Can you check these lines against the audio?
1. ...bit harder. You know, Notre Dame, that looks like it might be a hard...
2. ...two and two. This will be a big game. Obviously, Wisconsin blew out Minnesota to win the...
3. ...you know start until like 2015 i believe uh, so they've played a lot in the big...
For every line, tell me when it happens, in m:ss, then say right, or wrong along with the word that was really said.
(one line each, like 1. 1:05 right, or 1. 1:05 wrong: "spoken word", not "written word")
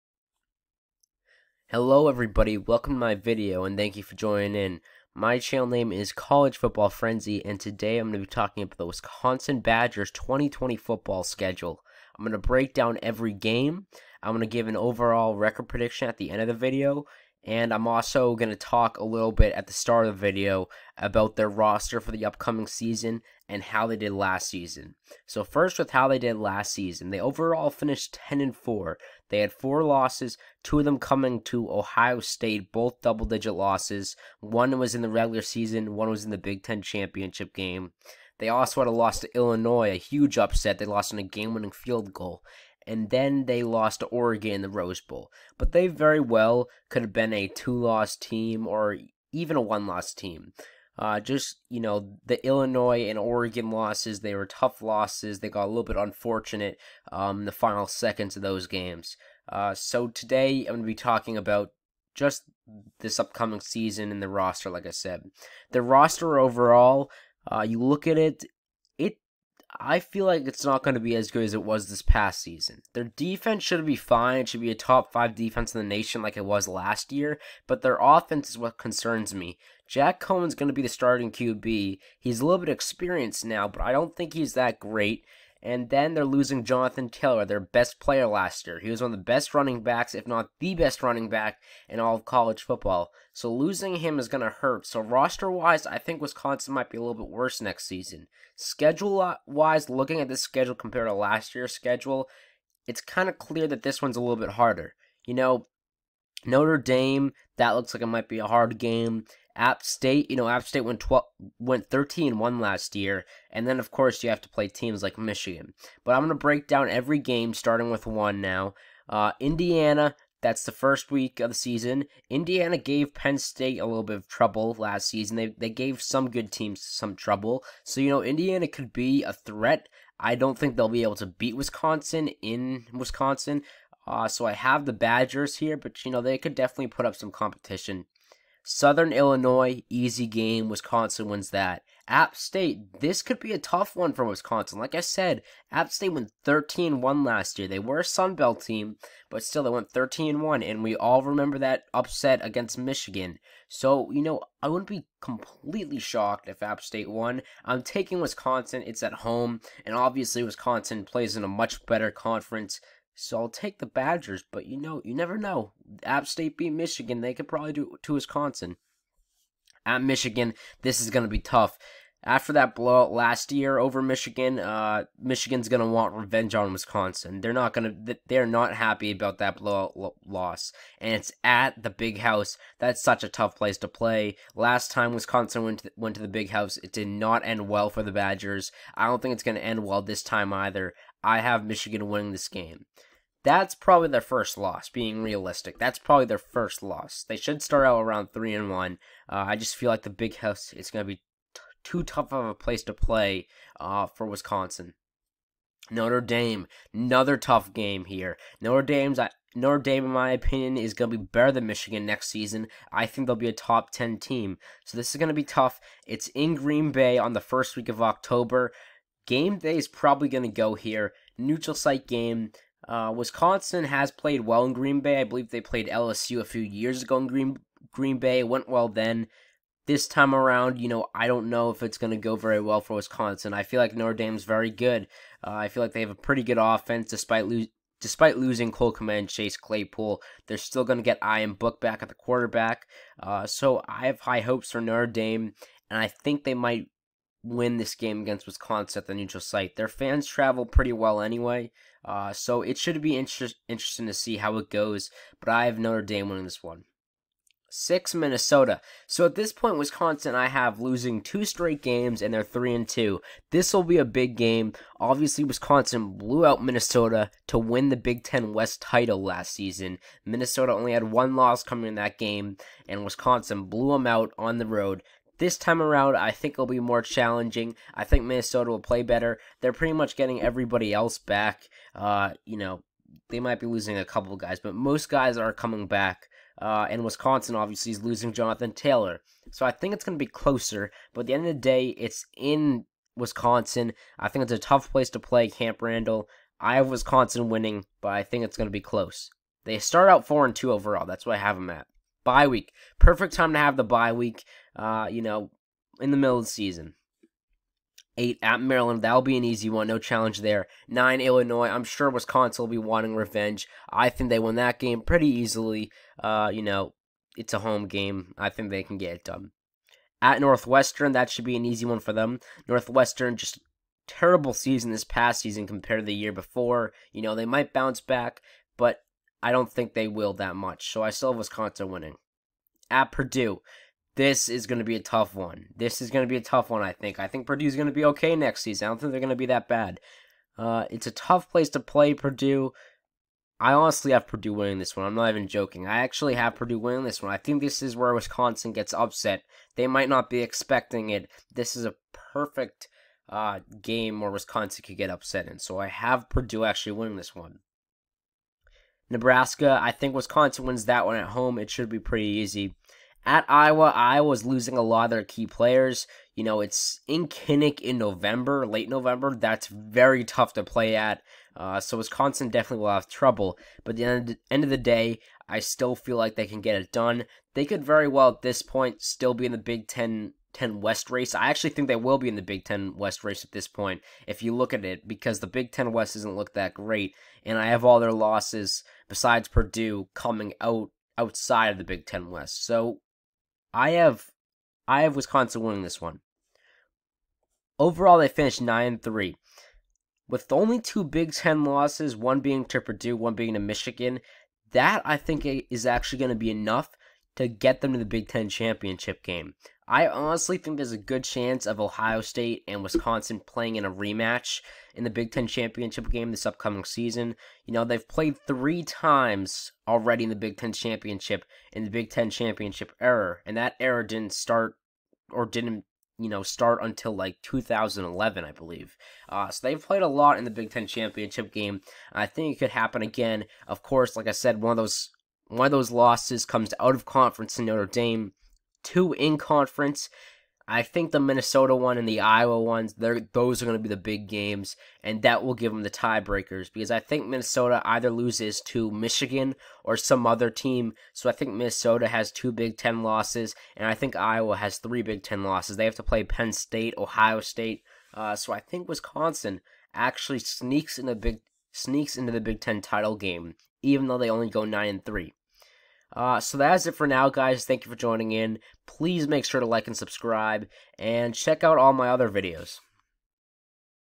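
1. 1:44 right
2. 4:22 wrong: "three", not "two"
3. 7:06 wrong: "2011", not "2015".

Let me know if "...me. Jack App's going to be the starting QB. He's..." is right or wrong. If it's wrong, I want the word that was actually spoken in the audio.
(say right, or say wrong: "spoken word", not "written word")
wrong: "Coan", not "App".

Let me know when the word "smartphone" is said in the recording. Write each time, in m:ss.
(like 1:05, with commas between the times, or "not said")
not said.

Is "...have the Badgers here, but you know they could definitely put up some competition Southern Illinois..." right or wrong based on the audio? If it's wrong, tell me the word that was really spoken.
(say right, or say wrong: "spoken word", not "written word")
right.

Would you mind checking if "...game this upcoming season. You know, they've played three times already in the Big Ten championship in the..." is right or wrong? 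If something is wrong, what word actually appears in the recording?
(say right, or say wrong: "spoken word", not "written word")
right.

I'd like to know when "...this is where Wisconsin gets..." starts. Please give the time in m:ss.
5:47.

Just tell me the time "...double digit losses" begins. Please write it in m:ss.
0:33.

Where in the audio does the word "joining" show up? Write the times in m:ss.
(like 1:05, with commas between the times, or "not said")
0:04, 7:47.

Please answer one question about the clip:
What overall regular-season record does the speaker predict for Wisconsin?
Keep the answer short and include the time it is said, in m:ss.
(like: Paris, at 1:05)
9-3, at 6:38.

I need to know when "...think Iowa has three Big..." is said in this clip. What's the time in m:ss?
7:33.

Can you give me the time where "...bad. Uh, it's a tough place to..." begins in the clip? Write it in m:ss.
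5:39.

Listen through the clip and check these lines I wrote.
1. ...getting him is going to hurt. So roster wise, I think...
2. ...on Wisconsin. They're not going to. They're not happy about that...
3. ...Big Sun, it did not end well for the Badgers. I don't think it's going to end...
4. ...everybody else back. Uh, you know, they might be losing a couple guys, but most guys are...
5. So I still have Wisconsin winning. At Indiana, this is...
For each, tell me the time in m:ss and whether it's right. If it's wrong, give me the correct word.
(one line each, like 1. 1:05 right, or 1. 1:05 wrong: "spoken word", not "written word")
1. 1:33 wrong: "losing", not "getting"
2. 2:56 right
3. 3:06 wrong: "House", not "Sun"
4. 4:40 right
5. 5:30 wrong: "Purdue", not "Indiana".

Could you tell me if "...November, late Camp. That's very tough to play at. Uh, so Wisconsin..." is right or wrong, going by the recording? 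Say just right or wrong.
wrong.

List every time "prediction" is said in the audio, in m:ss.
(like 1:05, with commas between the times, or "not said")
0:15.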